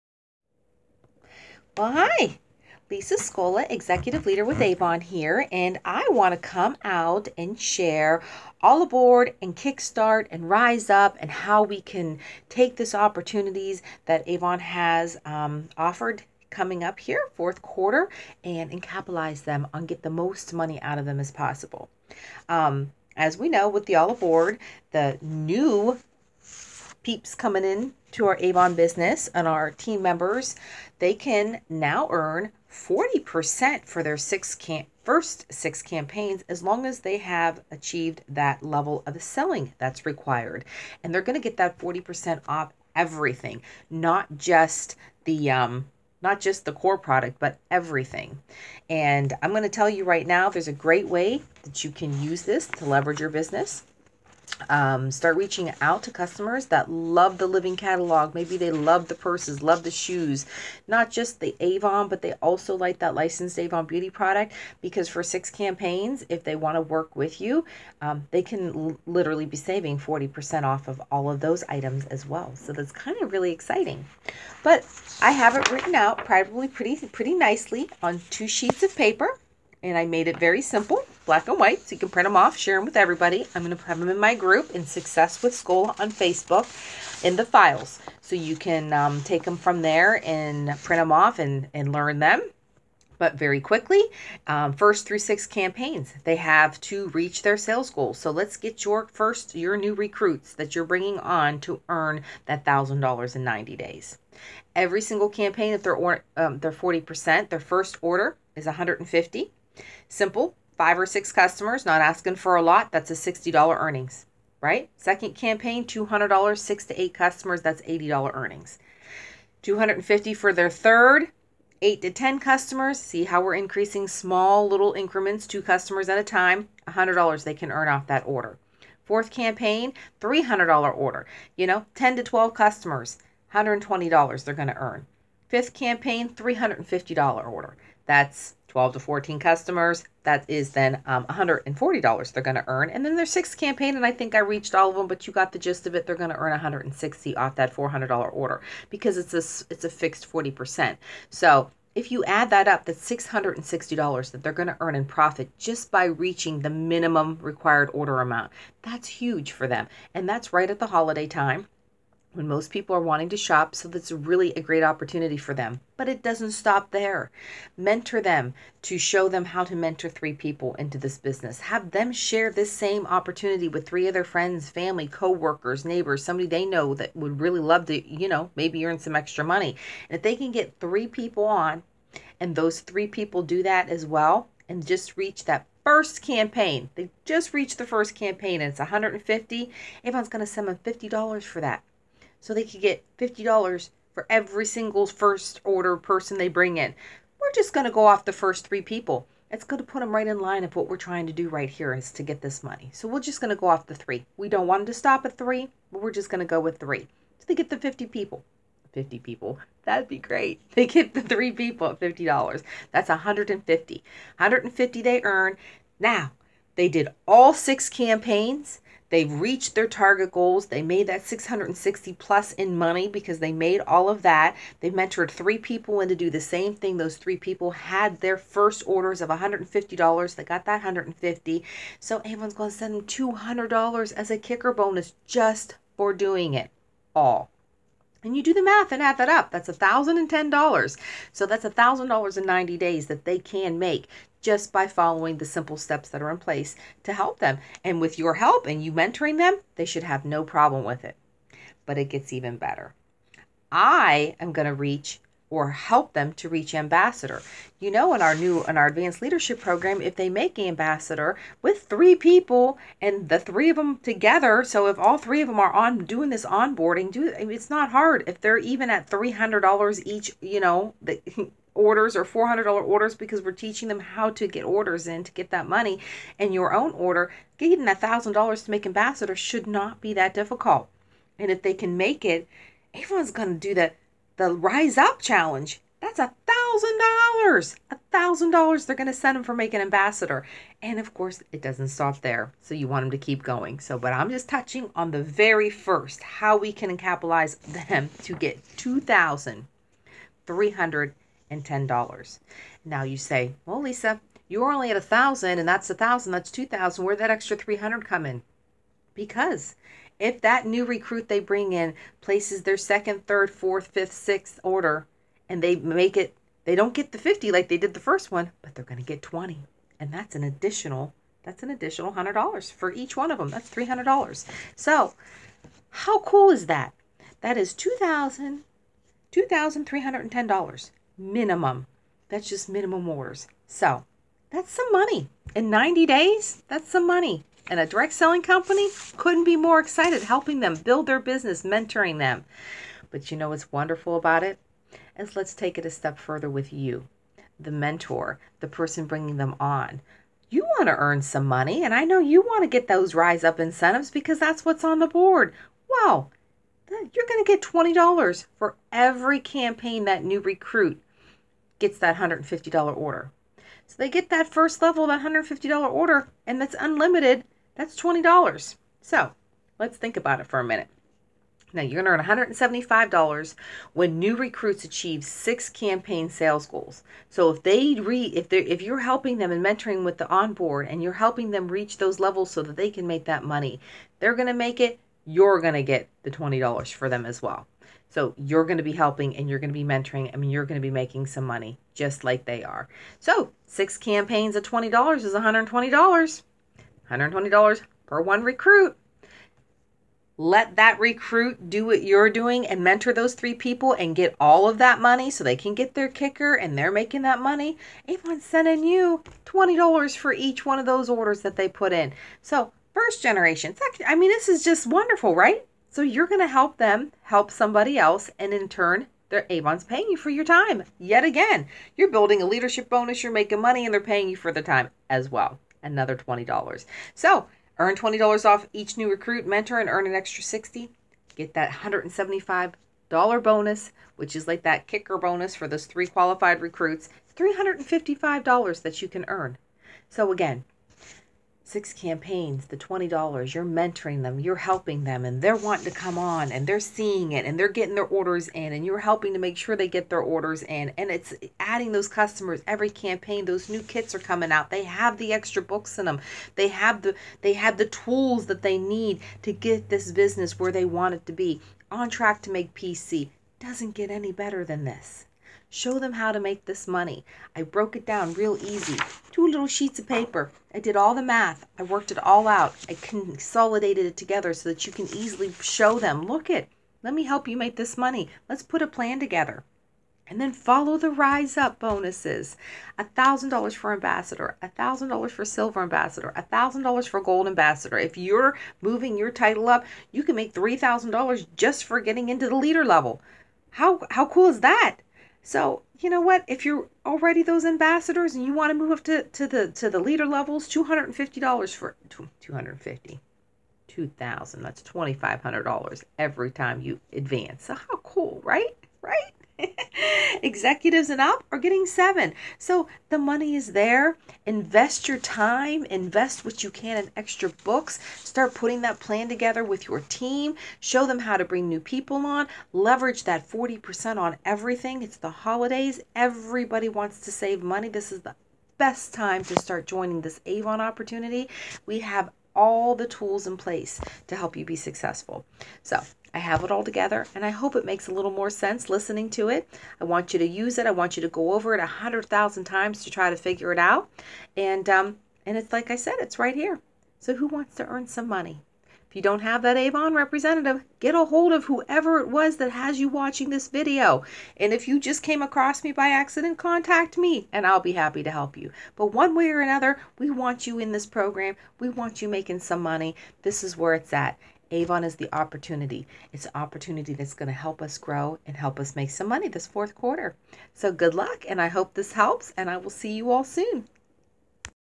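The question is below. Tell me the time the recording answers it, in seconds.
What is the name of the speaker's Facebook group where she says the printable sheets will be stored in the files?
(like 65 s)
84 s.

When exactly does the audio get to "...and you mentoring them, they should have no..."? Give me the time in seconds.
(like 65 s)
248 s.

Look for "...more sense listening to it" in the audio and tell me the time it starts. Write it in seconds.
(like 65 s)
538 s.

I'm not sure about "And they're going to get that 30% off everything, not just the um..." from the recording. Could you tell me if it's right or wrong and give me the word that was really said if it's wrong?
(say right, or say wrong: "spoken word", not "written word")
wrong: "40", not "30".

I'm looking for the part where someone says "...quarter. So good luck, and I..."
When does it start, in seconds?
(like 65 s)
569 s.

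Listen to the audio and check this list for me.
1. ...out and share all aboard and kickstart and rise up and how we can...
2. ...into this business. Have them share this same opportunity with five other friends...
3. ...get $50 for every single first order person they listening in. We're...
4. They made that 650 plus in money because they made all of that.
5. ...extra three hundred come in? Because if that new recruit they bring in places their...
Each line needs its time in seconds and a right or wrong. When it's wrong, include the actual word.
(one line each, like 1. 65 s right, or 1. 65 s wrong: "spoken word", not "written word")
1. 6 s right
2. 170 s wrong: "three", not "five"
3. 192 s wrong: "bring", not "listening"
4. 220 s wrong: "660", not "650"
5. 307 s right.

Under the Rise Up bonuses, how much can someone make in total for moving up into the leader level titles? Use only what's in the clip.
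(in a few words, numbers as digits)
$3,000.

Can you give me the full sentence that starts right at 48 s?
And I'm going to tell you right now, there's a great way that you can use this to leverage your business.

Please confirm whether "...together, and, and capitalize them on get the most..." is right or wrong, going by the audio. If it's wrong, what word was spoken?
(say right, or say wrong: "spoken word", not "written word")
wrong: "quarter", not "together".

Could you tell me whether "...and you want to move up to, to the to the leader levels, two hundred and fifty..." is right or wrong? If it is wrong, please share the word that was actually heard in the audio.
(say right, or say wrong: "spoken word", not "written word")
right.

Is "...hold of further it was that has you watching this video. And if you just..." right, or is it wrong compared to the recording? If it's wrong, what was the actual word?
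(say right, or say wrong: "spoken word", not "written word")
wrong: "whoever", not "further".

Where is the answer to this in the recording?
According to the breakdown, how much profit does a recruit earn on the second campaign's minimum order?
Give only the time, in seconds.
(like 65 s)
117 s.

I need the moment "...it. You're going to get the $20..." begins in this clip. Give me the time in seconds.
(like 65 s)
384 s.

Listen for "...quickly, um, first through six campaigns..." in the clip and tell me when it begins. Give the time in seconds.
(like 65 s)
93 s.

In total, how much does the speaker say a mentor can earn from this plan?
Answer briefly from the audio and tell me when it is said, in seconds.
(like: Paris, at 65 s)
$355, at 437 s.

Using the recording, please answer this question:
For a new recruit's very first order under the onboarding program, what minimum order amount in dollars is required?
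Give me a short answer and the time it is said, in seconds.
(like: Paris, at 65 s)
$150, at 108 s.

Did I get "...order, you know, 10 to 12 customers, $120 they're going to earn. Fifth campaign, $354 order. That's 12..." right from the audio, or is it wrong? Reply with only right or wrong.
wrong.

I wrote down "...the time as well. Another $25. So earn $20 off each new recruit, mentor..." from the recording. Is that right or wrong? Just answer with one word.
wrong.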